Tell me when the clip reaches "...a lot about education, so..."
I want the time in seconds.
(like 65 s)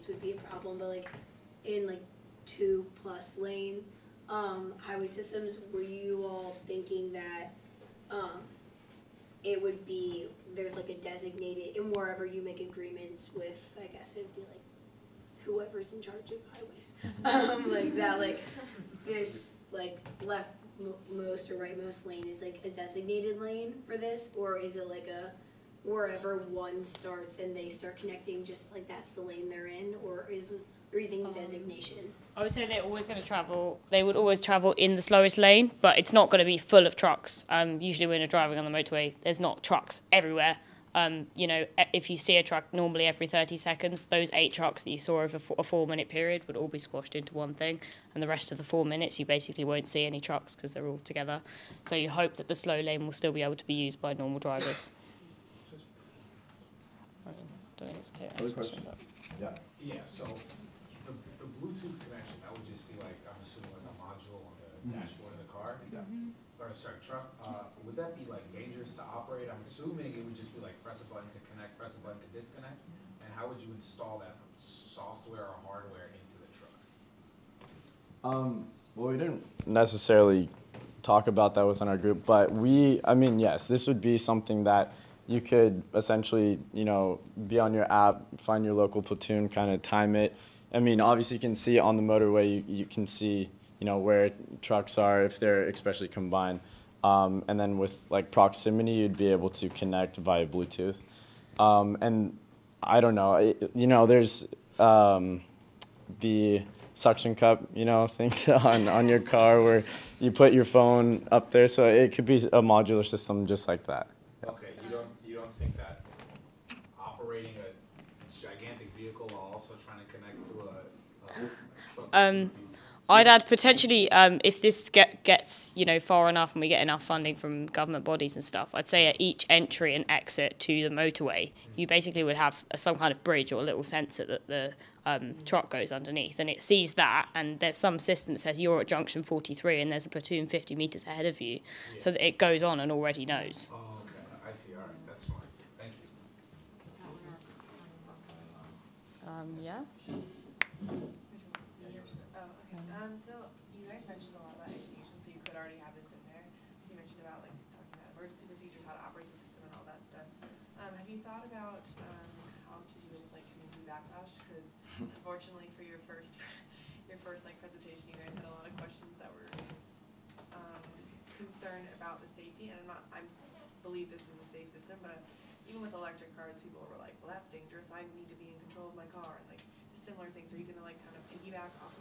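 154 s.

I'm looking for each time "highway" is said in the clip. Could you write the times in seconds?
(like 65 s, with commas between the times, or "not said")
4 s, 16 s.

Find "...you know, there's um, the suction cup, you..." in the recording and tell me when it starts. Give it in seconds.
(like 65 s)
103 s.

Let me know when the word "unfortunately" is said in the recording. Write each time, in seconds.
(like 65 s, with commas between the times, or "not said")
164 s.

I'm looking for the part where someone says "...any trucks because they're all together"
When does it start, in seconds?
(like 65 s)
50 s.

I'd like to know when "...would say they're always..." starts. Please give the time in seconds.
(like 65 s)
32 s.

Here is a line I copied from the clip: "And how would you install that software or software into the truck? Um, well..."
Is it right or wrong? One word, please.
wrong.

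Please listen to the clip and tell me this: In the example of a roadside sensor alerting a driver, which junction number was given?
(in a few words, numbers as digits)
43.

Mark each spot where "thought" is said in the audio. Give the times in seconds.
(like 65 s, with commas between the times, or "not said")
161 s.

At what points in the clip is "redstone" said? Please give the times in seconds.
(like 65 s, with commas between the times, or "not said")
not said.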